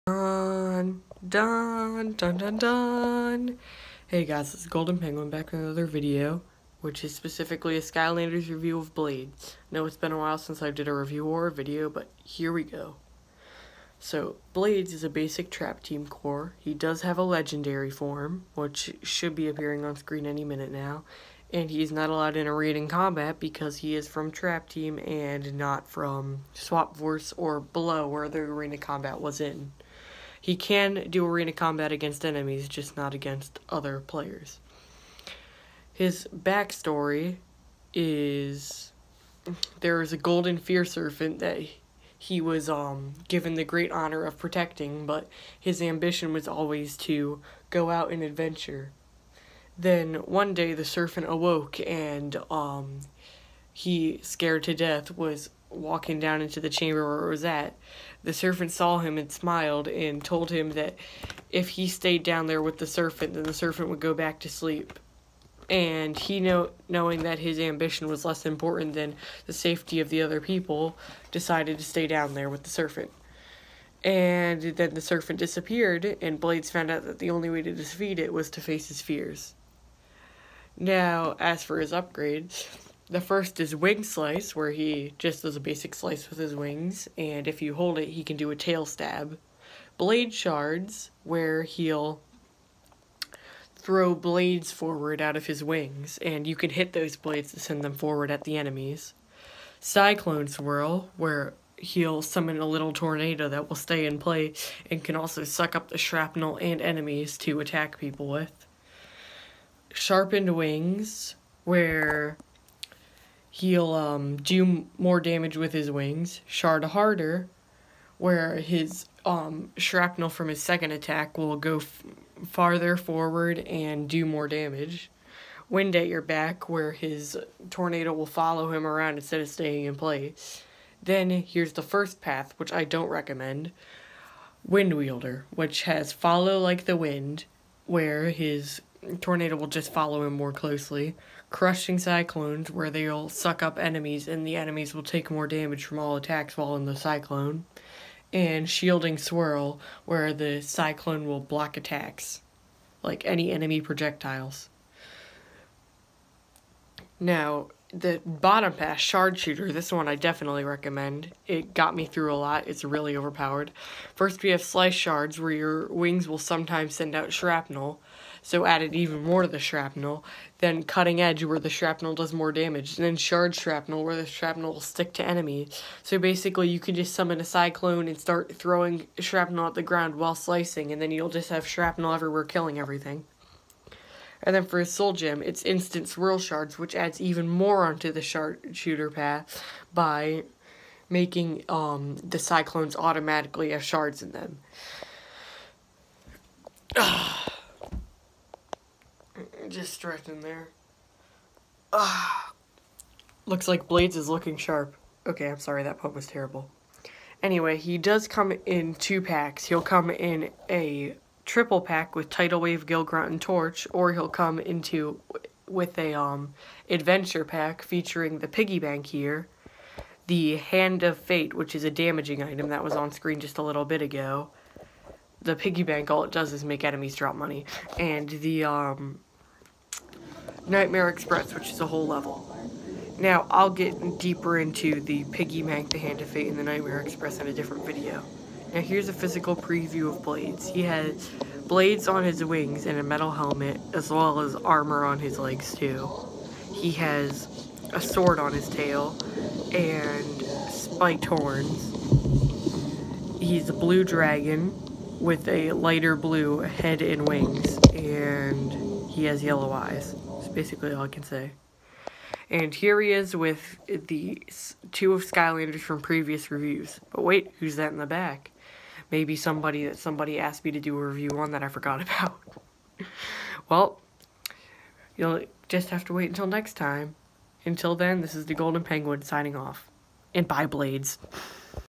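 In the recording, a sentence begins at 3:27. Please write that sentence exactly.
Anyway, he does come in two packs.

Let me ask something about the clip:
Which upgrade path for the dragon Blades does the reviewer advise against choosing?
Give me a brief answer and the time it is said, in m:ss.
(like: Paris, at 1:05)
Wind Wielder, at 2:14.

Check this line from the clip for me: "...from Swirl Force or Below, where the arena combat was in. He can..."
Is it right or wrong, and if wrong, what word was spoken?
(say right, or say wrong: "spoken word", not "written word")
wrong: "Swap", not "Swirl".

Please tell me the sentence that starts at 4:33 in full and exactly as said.
well, you'll just have to wait until next time.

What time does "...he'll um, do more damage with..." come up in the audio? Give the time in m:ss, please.
1:53.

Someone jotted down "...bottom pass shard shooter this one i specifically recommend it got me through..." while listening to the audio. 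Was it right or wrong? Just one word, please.
wrong.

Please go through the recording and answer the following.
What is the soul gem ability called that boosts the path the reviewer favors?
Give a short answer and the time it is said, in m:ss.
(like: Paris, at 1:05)
Instant Swirl Shards, at 3:05.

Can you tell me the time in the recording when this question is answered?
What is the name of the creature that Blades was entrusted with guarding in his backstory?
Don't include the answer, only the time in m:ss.
0:40.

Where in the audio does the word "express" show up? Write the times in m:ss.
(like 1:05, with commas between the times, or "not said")
3:51, 3:57.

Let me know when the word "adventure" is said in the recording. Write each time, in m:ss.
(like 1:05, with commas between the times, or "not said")
0:48, 3:36.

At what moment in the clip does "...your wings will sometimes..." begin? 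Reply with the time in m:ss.
2:45.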